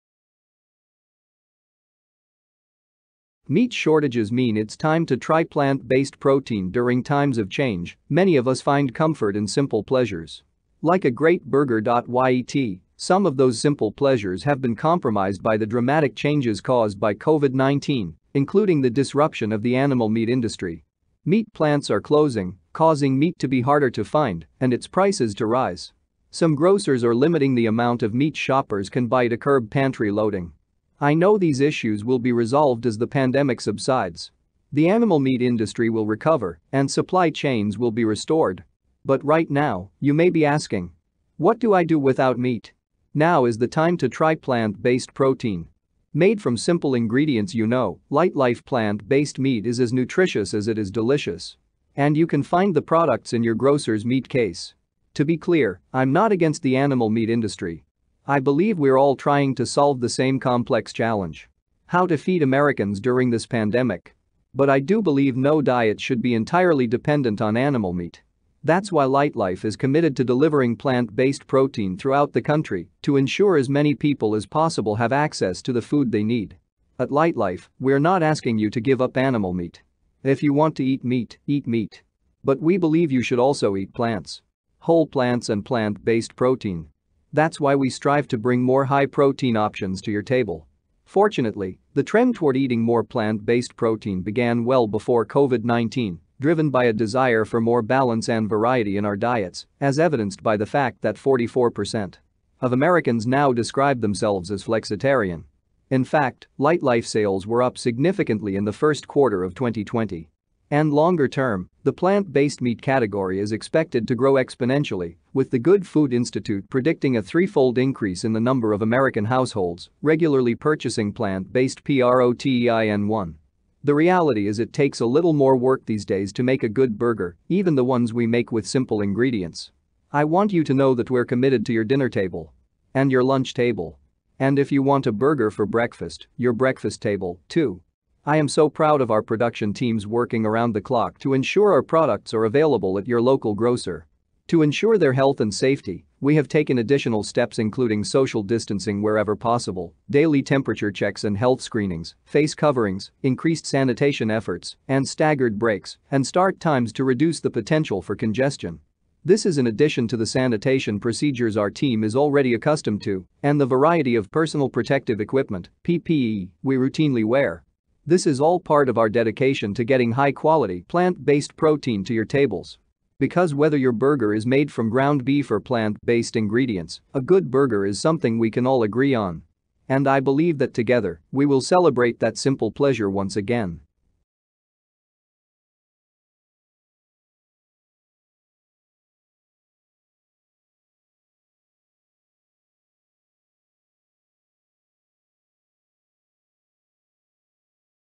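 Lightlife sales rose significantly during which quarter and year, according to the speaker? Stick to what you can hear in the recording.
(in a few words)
first quarter of 2020.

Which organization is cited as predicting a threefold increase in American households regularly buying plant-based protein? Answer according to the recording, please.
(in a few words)
Good Food Institute.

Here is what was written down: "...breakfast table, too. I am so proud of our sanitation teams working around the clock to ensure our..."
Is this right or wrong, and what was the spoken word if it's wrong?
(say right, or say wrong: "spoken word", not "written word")
wrong: "production", not "sanitation".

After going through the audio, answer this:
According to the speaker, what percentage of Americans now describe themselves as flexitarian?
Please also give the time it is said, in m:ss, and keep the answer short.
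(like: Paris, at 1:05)
44%, at 1:41.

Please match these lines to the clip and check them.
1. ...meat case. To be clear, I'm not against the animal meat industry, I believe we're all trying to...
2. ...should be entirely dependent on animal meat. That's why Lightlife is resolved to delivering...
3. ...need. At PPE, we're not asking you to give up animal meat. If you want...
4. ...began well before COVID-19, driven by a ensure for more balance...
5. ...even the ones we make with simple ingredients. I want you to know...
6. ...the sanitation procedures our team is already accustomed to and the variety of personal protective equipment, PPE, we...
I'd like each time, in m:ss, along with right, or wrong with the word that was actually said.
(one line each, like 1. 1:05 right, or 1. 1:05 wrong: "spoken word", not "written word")
1. 0:54 right
2. 1:05 wrong: "committed", not "resolved"
3. 1:16 wrong: "Lightlife", not "PPE"
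4. 1:34 wrong: "desire", not "ensure"
5. 2:07 right
6. 2:40 right.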